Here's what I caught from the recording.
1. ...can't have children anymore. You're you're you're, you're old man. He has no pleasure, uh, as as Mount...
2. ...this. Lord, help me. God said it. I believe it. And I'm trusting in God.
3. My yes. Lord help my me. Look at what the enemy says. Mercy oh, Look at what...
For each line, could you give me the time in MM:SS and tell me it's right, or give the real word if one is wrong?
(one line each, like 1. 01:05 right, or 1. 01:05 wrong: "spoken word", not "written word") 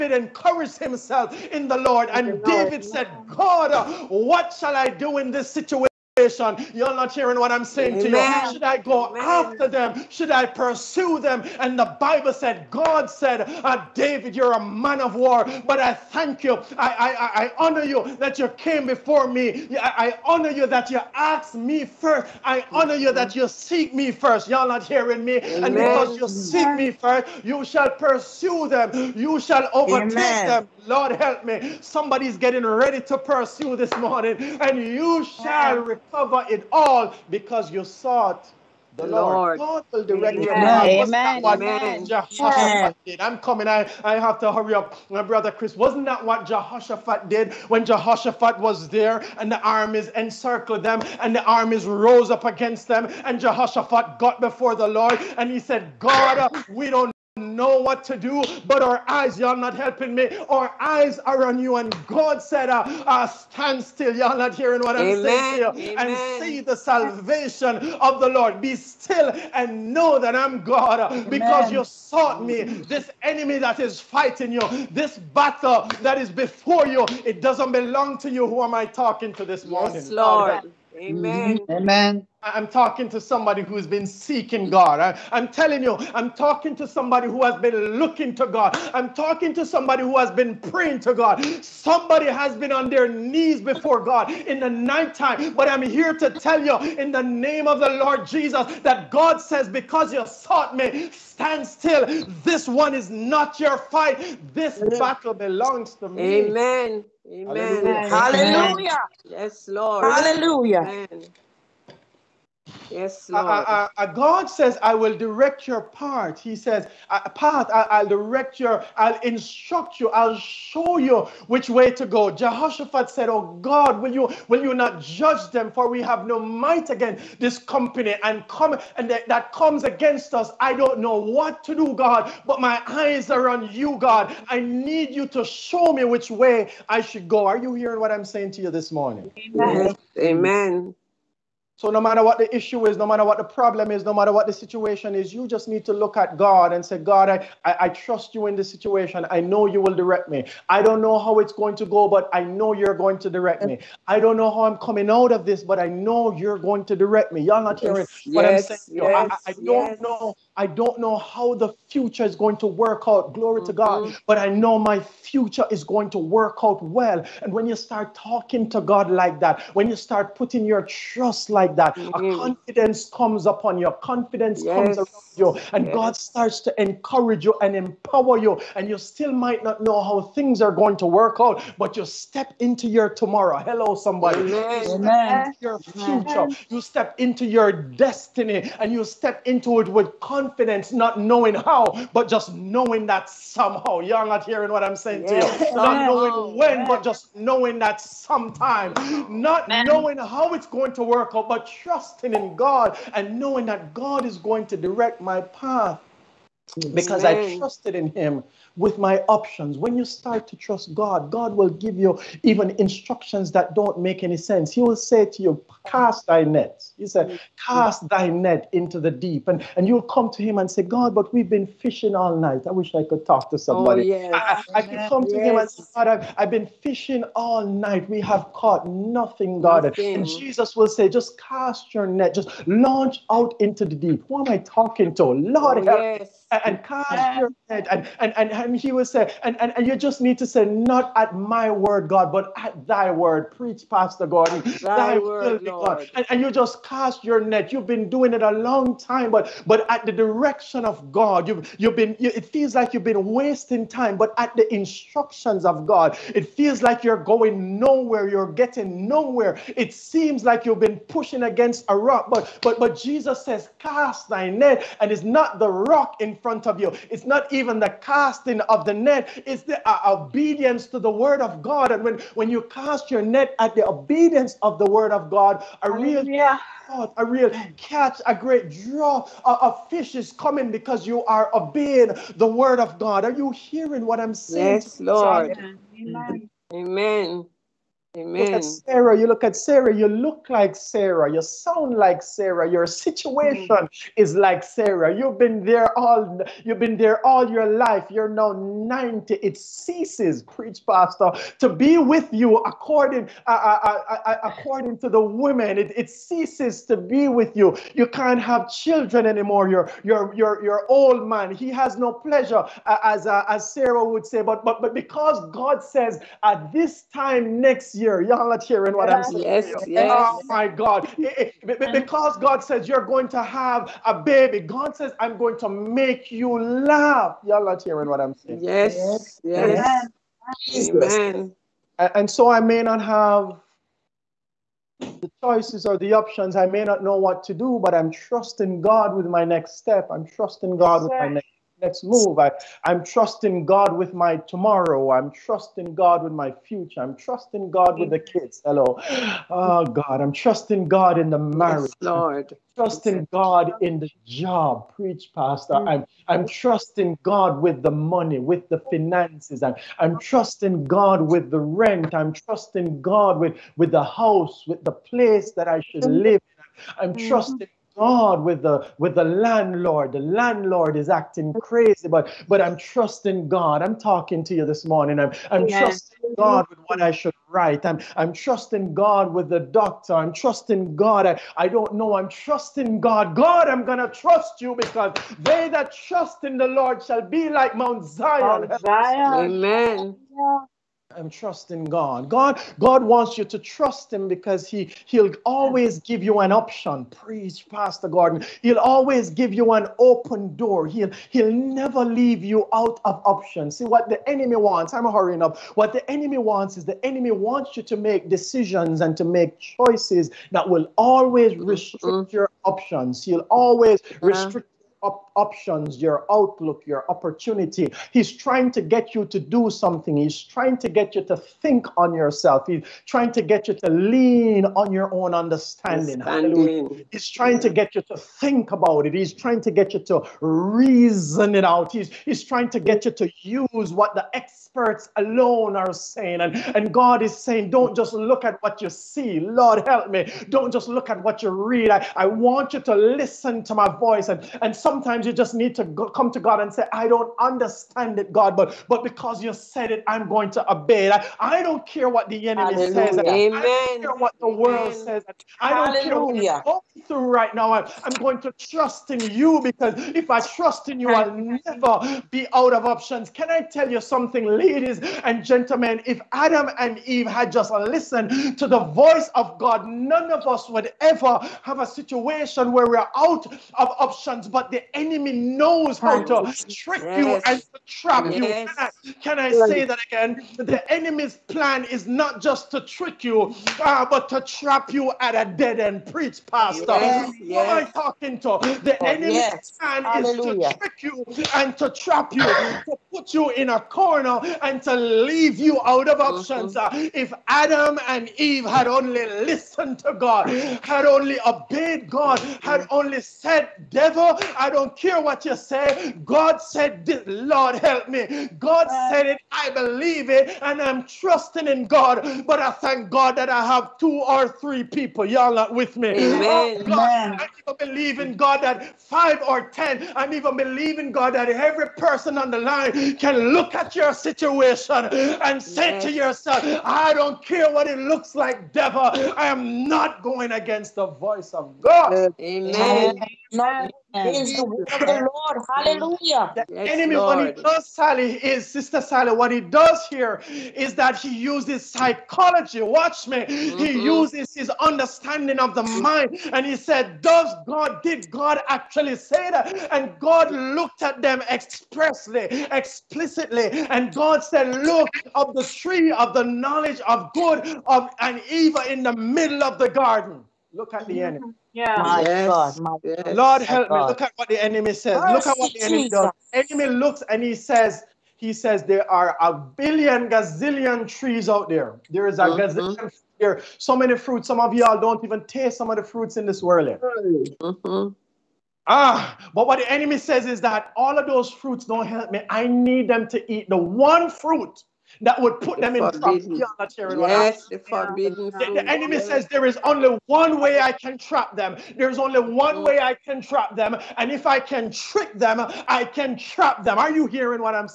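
1. 05:08 wrong: "Sarah", not "Mount"
2. 08:27 right
3. 09:22 right.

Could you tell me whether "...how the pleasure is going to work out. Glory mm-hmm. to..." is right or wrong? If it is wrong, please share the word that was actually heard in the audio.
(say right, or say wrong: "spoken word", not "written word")
wrong: "future", not "pleasure".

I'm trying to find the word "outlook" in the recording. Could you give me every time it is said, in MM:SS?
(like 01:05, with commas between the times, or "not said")
06:56.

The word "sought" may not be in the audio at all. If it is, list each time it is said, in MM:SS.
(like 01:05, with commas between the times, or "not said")
00:37, 01:11, 01:40.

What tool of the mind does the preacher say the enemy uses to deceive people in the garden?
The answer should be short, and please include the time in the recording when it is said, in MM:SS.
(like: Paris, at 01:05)
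psychology, at 09:01.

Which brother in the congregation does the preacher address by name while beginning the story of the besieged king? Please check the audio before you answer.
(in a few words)
Chris.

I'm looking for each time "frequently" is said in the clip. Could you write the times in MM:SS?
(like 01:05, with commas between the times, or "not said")
not said.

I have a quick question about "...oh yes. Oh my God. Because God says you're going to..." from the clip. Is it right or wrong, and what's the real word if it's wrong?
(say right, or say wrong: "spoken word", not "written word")
right.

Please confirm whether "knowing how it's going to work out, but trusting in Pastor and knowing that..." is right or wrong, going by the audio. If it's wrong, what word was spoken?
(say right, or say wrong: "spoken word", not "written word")
wrong: "God", not "Pastor".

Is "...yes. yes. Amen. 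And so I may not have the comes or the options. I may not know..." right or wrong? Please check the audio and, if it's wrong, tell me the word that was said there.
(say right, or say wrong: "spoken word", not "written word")
wrong: "choices", not "comes".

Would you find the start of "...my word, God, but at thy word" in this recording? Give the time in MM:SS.
04:01.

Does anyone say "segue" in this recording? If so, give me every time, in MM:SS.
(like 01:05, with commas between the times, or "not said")
not said.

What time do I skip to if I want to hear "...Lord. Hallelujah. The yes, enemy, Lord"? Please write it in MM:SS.
08:55.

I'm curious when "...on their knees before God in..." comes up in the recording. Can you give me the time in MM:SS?
01:32.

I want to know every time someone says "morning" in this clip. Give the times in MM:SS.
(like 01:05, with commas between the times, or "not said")
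00:33, 01:19, 02:18, 06:14.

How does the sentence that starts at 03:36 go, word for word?
He said, Cast thy net into the deep.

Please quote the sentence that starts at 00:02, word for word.
And David said, God, what shall I do in this situation?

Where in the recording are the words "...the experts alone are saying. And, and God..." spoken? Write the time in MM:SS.
07:14.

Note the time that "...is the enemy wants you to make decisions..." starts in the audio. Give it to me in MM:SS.
06:46.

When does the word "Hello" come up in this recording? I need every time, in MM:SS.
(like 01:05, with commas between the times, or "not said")
03:03, 05:48.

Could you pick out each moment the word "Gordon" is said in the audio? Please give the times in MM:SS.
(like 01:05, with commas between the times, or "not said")
04:04, 06:38.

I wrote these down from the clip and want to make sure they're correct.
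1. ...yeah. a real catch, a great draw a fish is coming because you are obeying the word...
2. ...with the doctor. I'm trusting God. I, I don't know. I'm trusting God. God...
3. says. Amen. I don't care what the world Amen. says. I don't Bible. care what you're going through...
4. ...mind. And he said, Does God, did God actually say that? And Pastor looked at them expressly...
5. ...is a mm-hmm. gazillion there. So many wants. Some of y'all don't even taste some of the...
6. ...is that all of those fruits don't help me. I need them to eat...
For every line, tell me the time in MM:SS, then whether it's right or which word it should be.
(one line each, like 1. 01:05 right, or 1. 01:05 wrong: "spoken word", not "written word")
1. 04:36 right
2. 06:19 right
3. 07:33 wrong: "Hallelujah", not "Bible"
4. 09:05 wrong: "God", not "Pastor"
5. 09:32 wrong: "fruits", not "wants"
6. 09:40 right.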